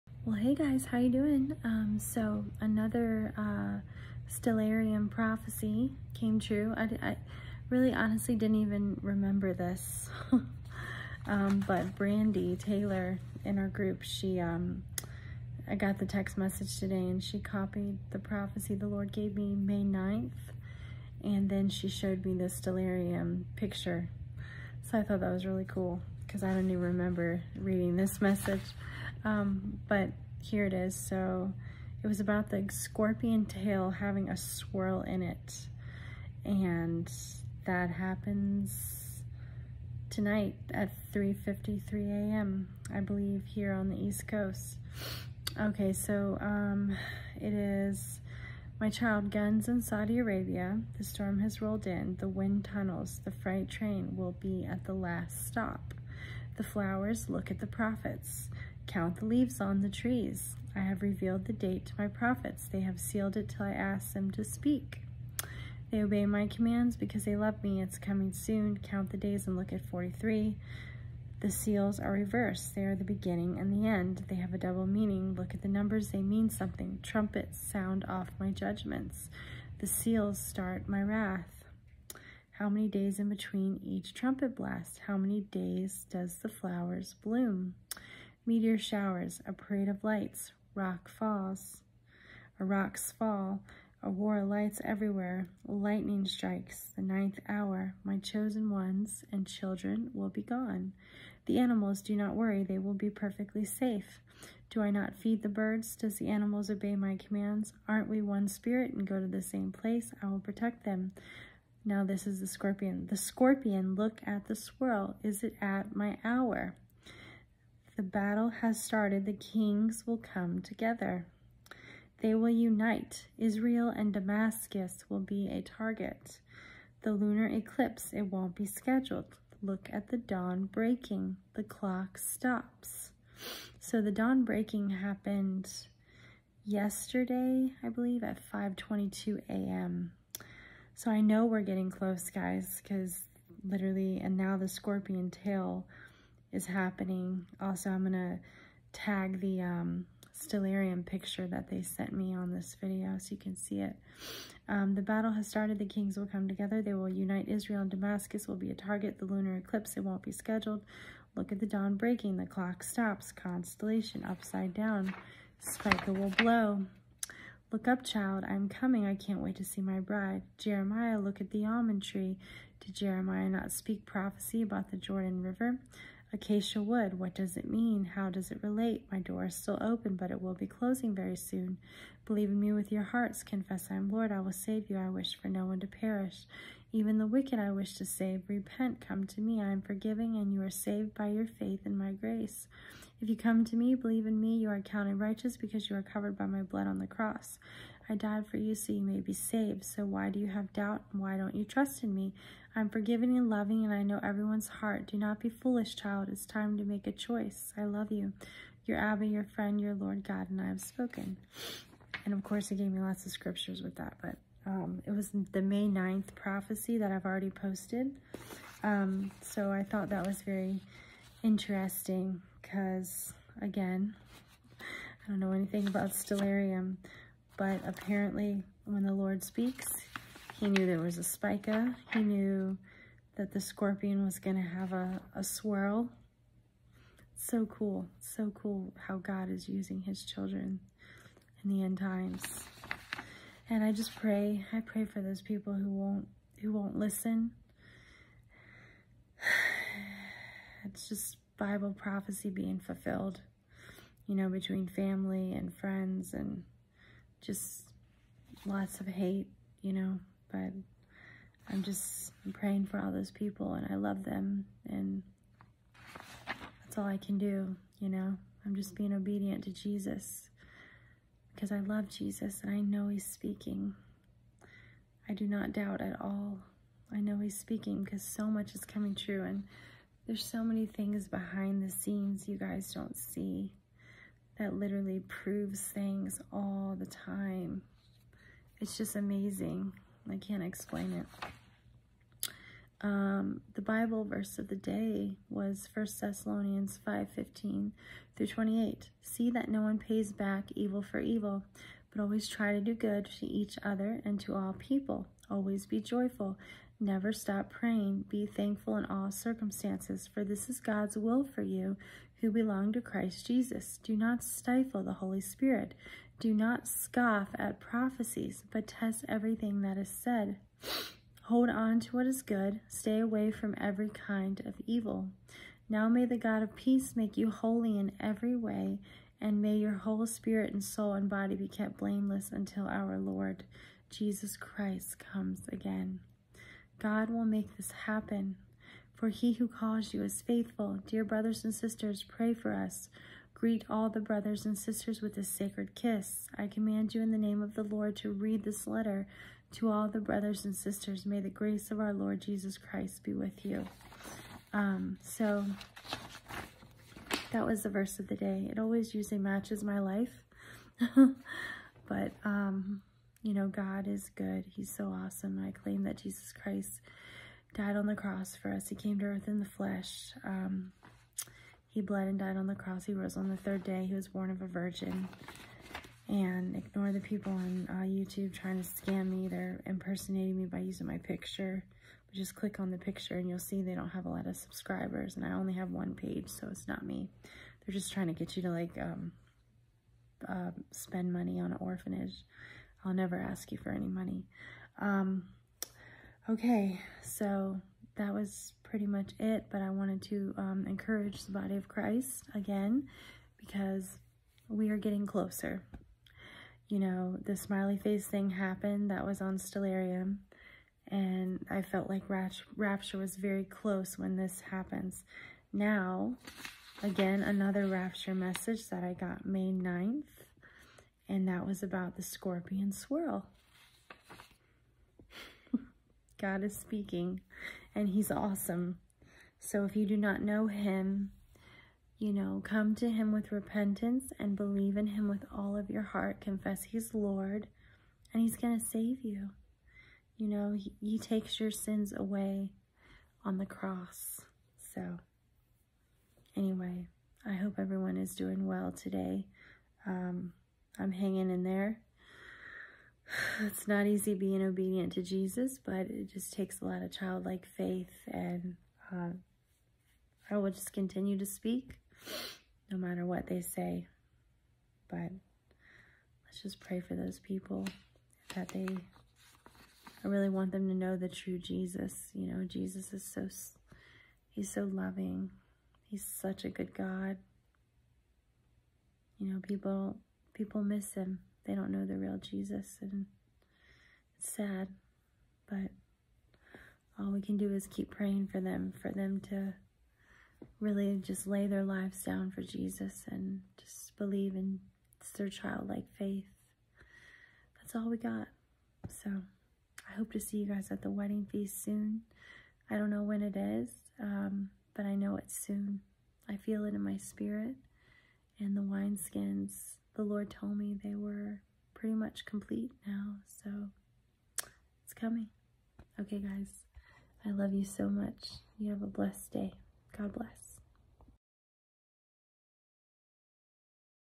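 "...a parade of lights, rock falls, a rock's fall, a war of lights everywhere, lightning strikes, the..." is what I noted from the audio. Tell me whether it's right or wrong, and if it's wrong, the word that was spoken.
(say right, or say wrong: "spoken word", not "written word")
right.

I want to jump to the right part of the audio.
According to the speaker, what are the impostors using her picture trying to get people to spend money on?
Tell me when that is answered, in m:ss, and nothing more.
6:31.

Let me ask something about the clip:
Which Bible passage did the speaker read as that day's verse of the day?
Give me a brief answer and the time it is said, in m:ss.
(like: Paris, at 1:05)
1 Thessalonians 5:15-28, at 4:55.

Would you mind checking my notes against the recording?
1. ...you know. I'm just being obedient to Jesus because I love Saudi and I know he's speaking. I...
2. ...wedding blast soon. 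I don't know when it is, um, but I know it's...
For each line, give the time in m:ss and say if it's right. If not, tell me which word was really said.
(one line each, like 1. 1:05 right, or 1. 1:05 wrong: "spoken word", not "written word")
1. 4:27 wrong: "Jesus", not "Saudi"
2. 8:21 wrong: "feast", not "blast".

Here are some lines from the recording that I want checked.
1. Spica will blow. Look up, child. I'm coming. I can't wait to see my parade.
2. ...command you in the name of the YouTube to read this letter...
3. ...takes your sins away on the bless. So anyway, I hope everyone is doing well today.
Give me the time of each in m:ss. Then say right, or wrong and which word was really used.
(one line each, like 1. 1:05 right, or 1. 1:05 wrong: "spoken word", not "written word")
1. 2:45 wrong: "bride", not "parade"
2. 5:46 wrong: "Lord", not "YouTube"
3. 7:21 wrong: "cross", not "bless".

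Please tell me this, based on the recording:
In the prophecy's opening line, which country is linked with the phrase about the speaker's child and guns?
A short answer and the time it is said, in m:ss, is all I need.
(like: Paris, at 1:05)
Saudi Arabia, at 0:49.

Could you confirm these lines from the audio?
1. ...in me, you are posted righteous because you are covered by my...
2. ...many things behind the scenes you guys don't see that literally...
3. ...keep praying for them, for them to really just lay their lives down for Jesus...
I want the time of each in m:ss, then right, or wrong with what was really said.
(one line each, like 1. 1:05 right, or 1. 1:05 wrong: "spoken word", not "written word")
1. 3:14 wrong: "counted", not "posted"
2. 4:40 right
3. 8:07 right.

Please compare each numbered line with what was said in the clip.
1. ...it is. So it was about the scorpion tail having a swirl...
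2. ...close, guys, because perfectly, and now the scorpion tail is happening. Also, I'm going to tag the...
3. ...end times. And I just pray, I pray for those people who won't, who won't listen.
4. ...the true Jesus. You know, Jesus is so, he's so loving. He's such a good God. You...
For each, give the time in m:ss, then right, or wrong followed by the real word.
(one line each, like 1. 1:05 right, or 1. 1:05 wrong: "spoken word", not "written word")
1. 0:30 right
2. 2:21 wrong: "literally", not "perfectly"
3. 4:01 right
4. 7:51 right.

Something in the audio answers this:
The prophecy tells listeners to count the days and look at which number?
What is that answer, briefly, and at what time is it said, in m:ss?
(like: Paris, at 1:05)
43, at 1:09.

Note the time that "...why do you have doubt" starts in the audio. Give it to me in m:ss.
3:20.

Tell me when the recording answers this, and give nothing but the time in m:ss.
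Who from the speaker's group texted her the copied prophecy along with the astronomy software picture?
0:11.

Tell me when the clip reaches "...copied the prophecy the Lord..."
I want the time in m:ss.
0:17.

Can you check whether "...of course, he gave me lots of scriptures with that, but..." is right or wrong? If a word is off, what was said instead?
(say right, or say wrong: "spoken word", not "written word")
right.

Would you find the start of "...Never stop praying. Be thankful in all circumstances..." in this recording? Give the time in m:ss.
5:07.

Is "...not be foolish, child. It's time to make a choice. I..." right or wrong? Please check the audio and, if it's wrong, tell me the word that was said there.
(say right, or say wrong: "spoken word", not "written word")
right.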